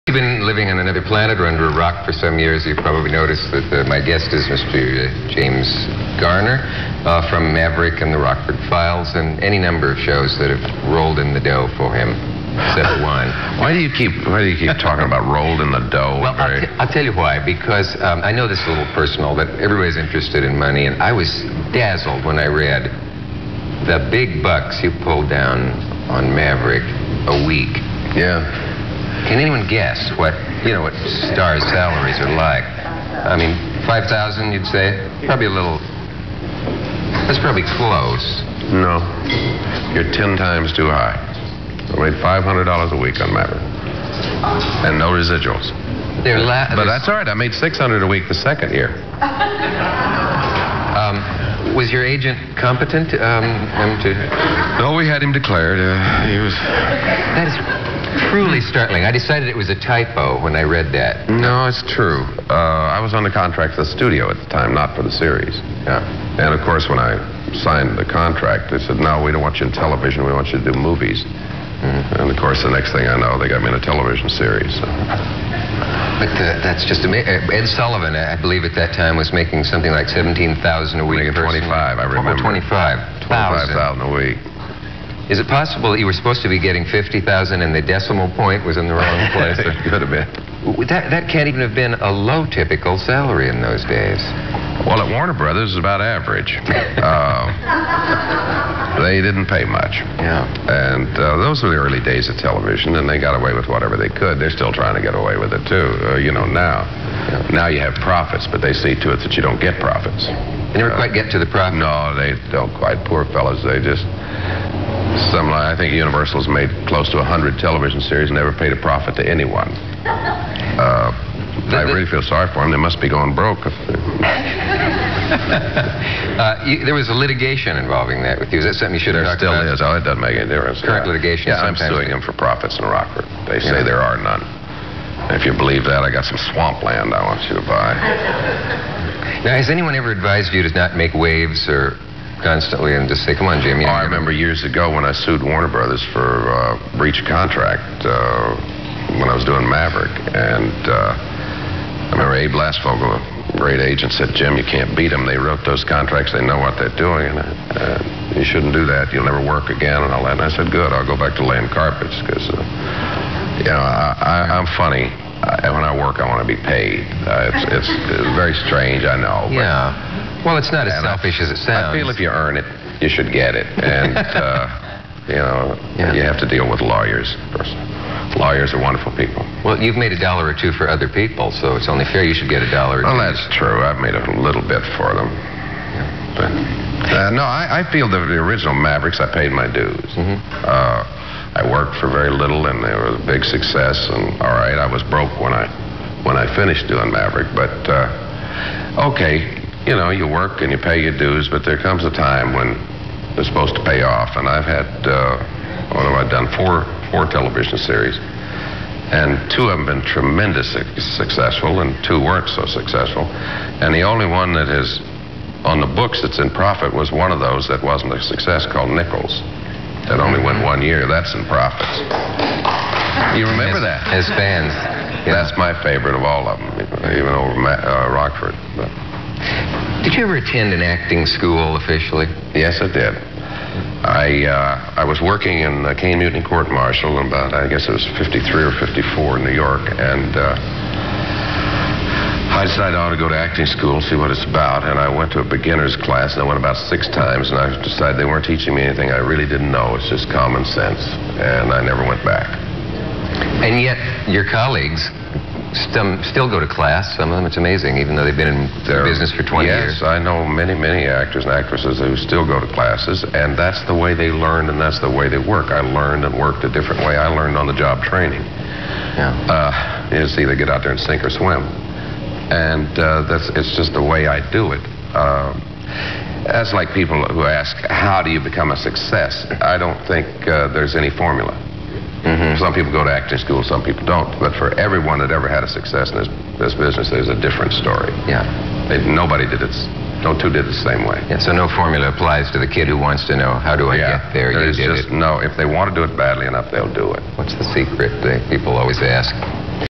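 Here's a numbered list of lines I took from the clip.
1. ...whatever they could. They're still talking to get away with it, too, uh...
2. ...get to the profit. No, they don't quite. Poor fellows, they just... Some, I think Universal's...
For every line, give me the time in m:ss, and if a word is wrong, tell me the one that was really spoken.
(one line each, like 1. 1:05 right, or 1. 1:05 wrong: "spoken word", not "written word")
1. 1:43 wrong: "trying", not "talking"
2. 1:51 right.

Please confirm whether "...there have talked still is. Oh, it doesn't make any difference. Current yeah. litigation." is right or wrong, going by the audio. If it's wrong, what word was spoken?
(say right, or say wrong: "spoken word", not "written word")
right.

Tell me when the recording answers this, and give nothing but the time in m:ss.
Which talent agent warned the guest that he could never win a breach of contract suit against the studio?
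2:32.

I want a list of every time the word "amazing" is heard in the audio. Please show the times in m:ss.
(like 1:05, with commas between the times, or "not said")
1:17, 4:17.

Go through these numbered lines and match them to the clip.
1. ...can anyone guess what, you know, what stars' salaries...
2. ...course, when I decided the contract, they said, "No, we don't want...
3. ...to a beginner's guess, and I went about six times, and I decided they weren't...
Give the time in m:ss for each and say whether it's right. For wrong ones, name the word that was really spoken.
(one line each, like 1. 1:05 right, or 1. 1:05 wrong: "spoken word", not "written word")
1. 0:29 right
2. 1:06 wrong: "signed", not "decided"
3. 4:05 wrong: "class", not "guess".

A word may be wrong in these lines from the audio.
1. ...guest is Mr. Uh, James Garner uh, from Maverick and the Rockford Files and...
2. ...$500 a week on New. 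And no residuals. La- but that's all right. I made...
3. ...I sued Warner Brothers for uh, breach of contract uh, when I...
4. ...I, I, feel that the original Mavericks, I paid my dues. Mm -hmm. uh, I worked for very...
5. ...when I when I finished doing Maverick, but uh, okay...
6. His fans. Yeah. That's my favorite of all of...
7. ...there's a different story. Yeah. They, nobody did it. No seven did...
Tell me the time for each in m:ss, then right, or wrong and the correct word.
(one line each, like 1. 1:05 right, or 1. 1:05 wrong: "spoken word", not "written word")
1. 0:04 right
2. 0:42 wrong: "Maverick", not "New"
3. 2:25 right
4. 3:07 right
5. 3:15 right
6. 3:44 right
7. 4:47 wrong: "two", not "seven".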